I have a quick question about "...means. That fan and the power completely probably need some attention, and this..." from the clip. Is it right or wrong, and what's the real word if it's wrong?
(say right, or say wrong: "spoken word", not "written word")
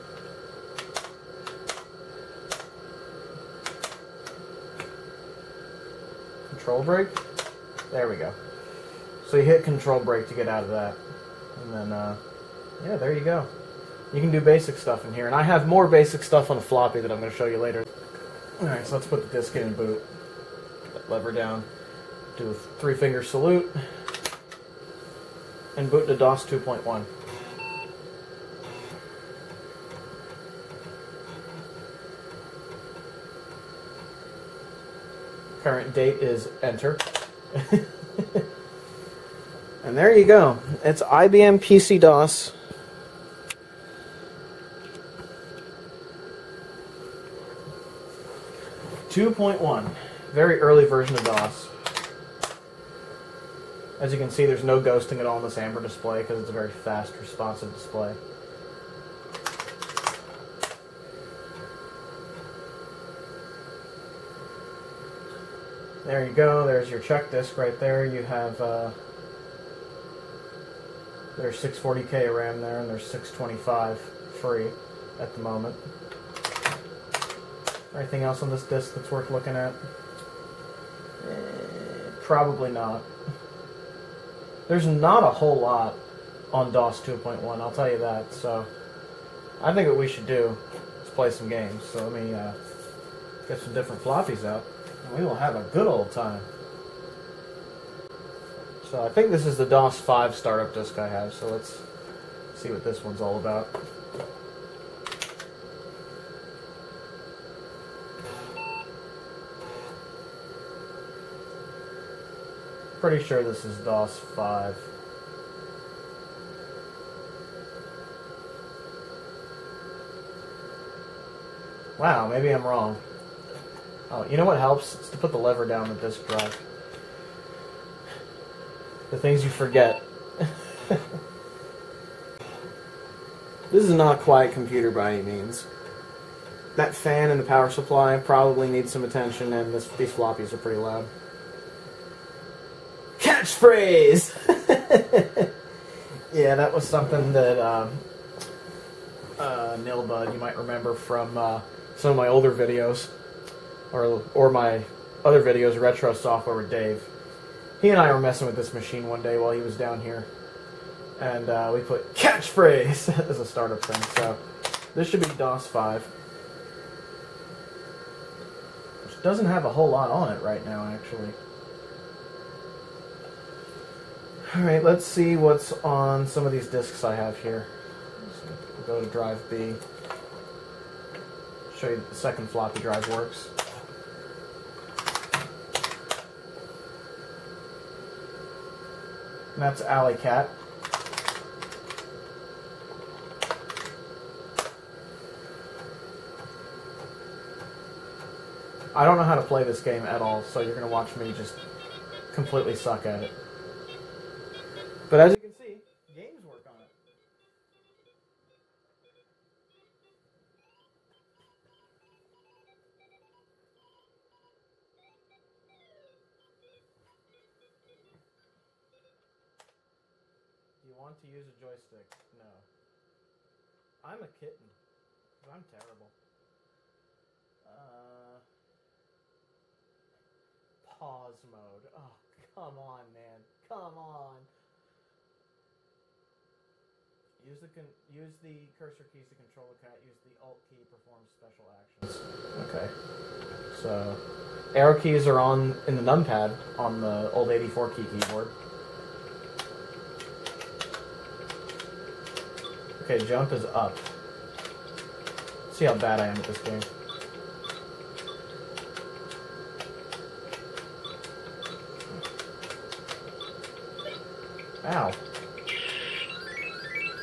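wrong: "supply", not "completely".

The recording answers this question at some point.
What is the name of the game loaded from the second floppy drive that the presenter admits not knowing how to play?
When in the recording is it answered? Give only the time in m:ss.
3:09.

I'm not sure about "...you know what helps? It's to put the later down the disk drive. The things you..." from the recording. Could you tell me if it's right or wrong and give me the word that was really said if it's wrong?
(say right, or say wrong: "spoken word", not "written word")
wrong: "lever", not "later".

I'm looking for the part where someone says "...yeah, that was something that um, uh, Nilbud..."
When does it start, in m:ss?
2:26.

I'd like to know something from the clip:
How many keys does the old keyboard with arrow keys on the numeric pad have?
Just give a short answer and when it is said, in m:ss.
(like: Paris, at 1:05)
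84, at 4:07.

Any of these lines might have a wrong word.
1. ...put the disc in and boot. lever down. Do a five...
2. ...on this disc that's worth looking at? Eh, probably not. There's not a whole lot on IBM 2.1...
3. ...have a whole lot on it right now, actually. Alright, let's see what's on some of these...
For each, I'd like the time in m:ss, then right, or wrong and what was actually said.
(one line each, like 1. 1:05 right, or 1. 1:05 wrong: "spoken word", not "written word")
1. 0:19 wrong: "three", not "five"
2. 1:18 wrong: "DOS", not "IBM"
3. 2:49 right.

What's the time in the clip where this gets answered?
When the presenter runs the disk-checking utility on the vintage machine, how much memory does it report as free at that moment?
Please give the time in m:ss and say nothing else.
1:13.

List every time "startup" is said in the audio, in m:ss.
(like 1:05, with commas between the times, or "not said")
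1:40, 2:43.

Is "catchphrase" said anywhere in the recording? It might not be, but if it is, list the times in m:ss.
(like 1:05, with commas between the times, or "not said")
2:23, 2:42.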